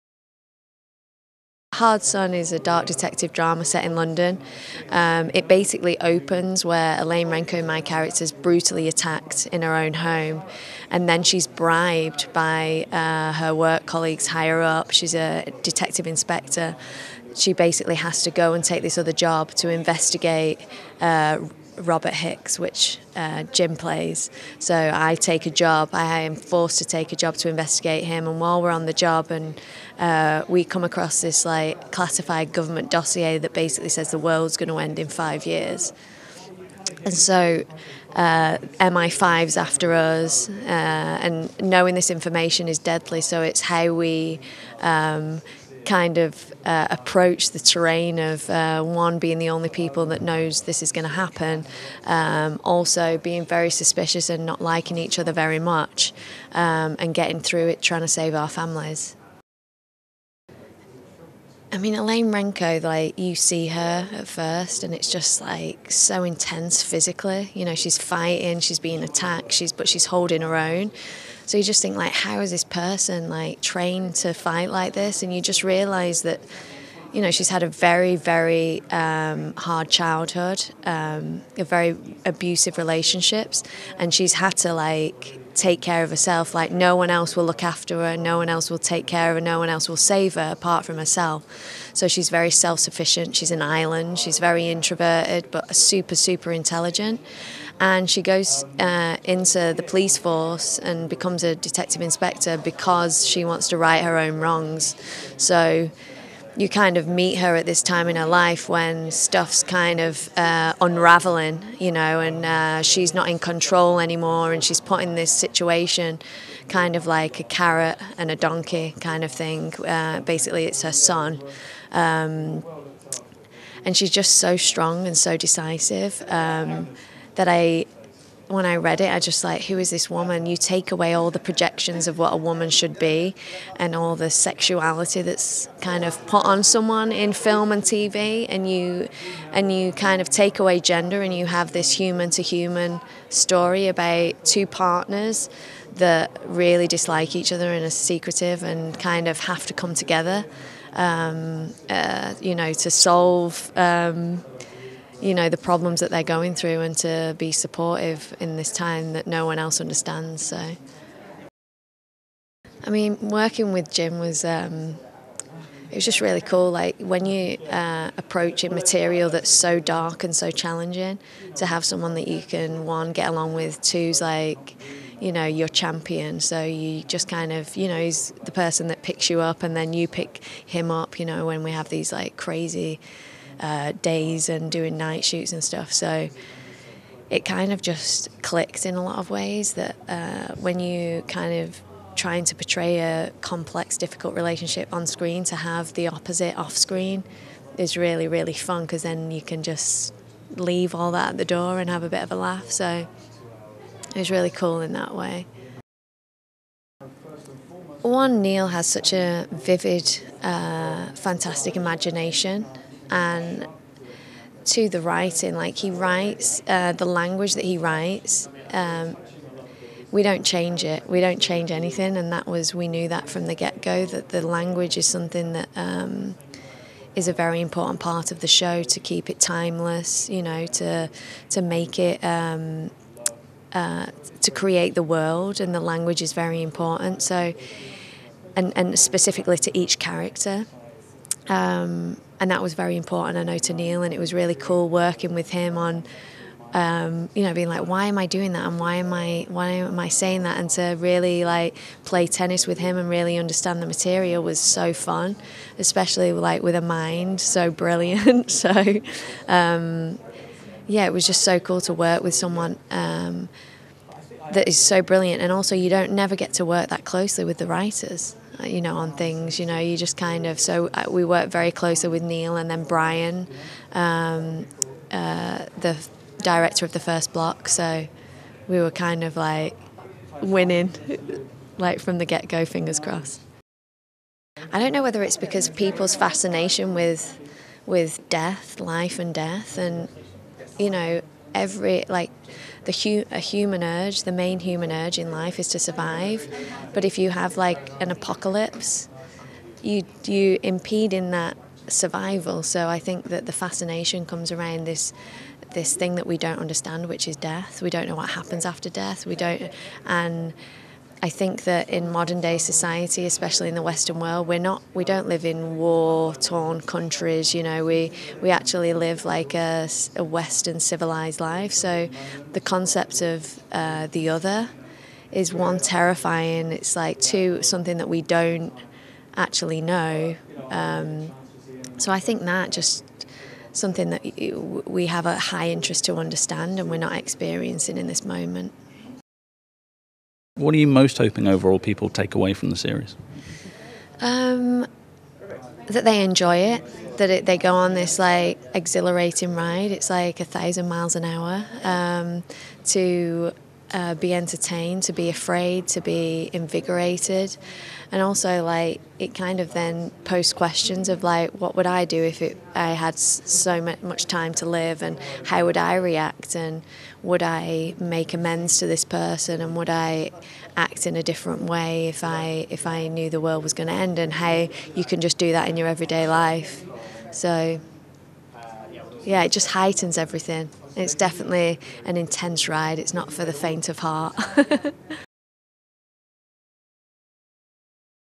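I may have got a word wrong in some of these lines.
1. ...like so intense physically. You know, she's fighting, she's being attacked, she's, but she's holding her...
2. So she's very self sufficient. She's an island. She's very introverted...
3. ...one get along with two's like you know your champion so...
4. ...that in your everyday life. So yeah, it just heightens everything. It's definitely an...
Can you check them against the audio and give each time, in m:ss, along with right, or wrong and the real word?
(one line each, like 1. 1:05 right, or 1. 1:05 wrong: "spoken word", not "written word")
1. 1:05 right
2. 1:31 right
3. 2:52 right
4. 6:15 right.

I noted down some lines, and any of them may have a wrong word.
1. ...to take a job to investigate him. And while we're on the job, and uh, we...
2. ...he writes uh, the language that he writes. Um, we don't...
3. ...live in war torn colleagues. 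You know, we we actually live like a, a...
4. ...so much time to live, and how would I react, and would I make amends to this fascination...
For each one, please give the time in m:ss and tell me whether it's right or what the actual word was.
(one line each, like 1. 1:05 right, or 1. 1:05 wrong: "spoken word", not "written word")
1. 0:26 right
2. 3:35 right
3. 5:15 wrong: "countries", not "colleagues"
4. 6:03 wrong: "person", not "fascination".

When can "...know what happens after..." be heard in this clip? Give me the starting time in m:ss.
5:08.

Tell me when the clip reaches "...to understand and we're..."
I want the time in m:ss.
5:36.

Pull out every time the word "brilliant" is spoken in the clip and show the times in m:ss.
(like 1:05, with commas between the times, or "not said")
4:17, 4:25.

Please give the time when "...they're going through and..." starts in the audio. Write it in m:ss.
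2:36.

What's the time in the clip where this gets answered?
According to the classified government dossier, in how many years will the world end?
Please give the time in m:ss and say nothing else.
0:35.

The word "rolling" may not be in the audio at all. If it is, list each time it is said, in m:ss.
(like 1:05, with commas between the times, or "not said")
not said.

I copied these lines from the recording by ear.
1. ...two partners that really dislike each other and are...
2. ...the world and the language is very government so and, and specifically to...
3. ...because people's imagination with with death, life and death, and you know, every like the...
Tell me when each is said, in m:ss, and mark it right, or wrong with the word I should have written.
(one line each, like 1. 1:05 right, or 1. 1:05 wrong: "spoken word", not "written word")
1. 2:24 right
2. 3:54 wrong: "important", not "government"
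3. 4:45 wrong: "fascination", not "imagination".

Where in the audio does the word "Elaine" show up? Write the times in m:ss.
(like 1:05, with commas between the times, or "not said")
0:07, 1:01.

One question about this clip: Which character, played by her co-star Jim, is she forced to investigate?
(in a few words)
Robert Hicks.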